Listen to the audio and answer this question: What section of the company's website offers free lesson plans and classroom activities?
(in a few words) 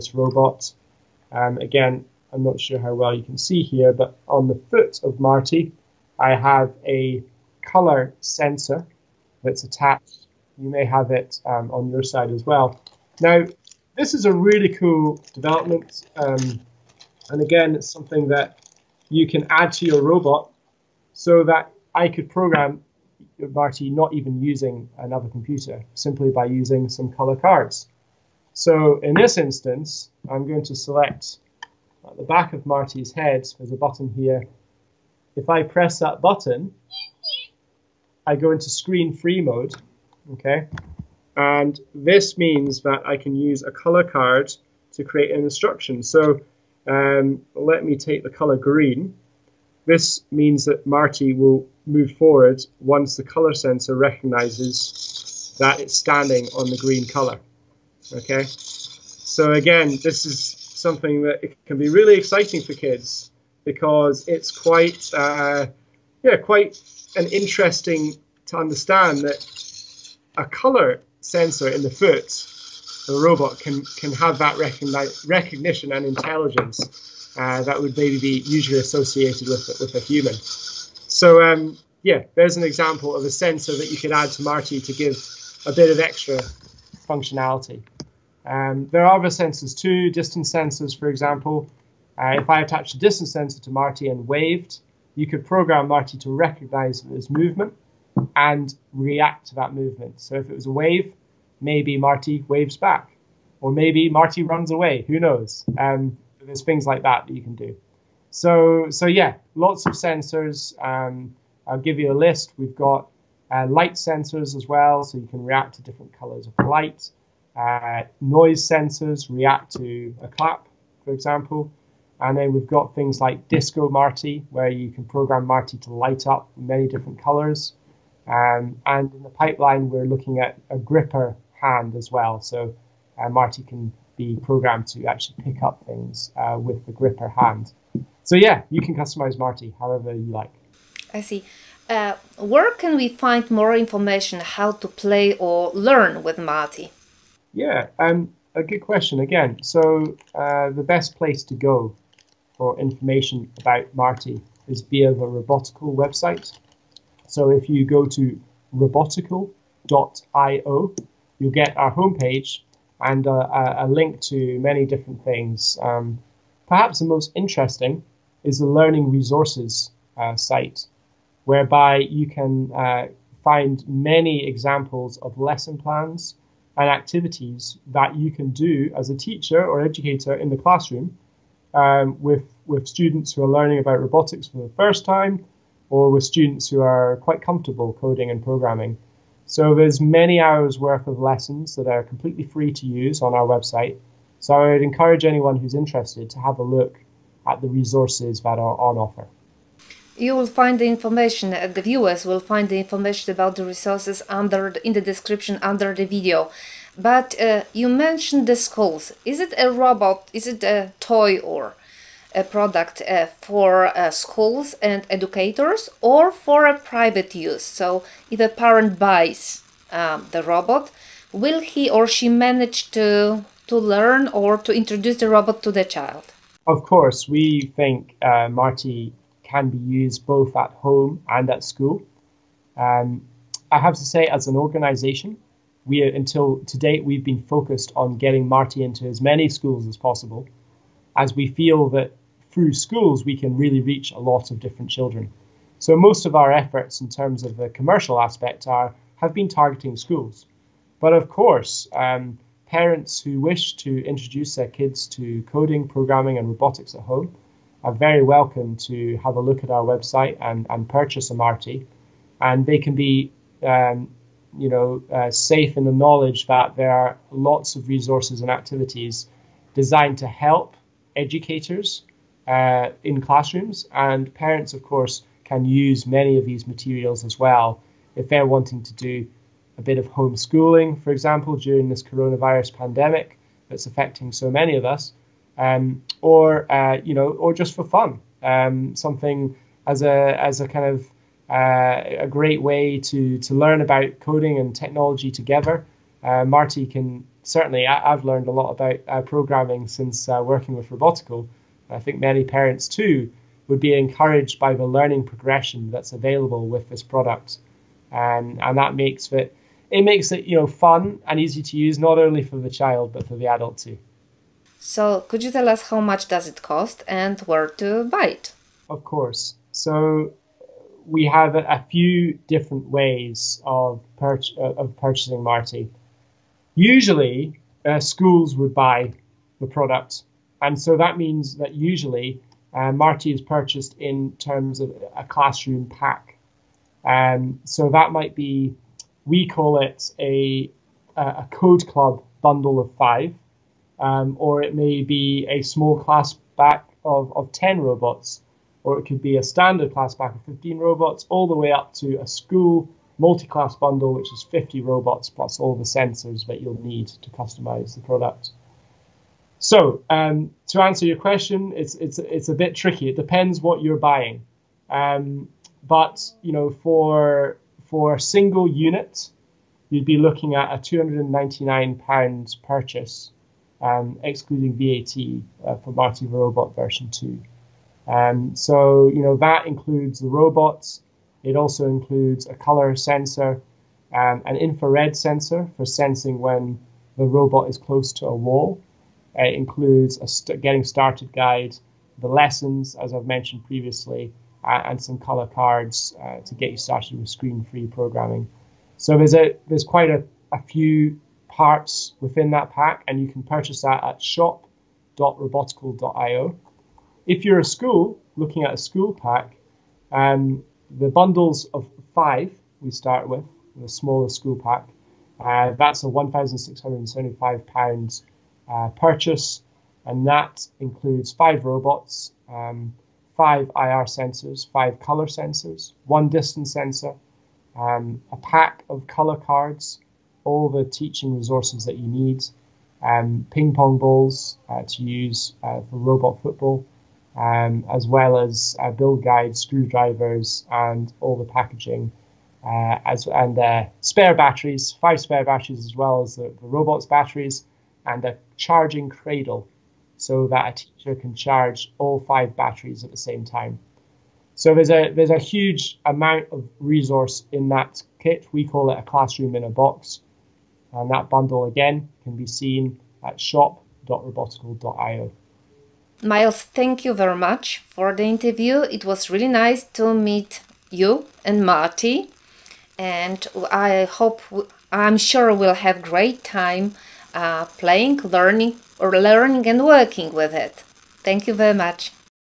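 Learning Resources.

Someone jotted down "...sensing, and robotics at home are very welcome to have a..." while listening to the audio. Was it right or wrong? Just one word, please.
wrong.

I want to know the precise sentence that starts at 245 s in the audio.
So most of our efforts in terms of the commercial aspect are have been targeting schools, but of course.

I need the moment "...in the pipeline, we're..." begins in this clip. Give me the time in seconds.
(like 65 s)
129 s.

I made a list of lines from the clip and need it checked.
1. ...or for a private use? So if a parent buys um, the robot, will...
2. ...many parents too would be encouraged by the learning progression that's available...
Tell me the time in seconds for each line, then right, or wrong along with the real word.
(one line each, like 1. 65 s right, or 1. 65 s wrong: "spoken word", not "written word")
1. 216 s right
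2. 302 s right.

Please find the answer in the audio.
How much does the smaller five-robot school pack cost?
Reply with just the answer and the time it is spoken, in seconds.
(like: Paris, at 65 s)
£1,675, at 416 s.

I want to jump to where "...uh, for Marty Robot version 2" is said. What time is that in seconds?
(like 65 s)
375 s.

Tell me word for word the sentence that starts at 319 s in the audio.
So we have a, few different ways of, pur- uh, of purchasing Marty.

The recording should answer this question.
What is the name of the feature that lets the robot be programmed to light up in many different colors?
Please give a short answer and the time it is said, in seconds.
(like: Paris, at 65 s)
Disco Marty, at 123 s.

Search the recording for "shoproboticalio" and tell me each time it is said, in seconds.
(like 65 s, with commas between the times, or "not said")
404 s, 463 s.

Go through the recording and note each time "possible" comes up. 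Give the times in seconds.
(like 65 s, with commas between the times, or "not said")
239 s.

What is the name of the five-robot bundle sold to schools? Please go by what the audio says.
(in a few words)
Code club bundle.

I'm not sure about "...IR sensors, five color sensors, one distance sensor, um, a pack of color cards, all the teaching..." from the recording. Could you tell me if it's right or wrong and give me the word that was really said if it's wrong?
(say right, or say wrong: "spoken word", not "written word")
right.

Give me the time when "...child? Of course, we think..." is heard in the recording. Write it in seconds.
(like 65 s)
225 s.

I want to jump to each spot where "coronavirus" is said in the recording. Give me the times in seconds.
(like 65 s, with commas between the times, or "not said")
282 s.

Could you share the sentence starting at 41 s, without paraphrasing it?
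And this means that I can use a color card to create an instruction.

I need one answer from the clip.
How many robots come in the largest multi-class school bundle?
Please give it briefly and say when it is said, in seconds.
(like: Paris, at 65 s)
50, at 354 s.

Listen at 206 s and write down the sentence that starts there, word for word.
But uh, you mentioned the skulls.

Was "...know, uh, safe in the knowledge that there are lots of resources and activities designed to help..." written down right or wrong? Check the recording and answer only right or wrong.
right.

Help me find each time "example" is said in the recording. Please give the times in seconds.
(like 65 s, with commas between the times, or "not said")
82 s, 91 s, 121 s, 174 s, 281 s.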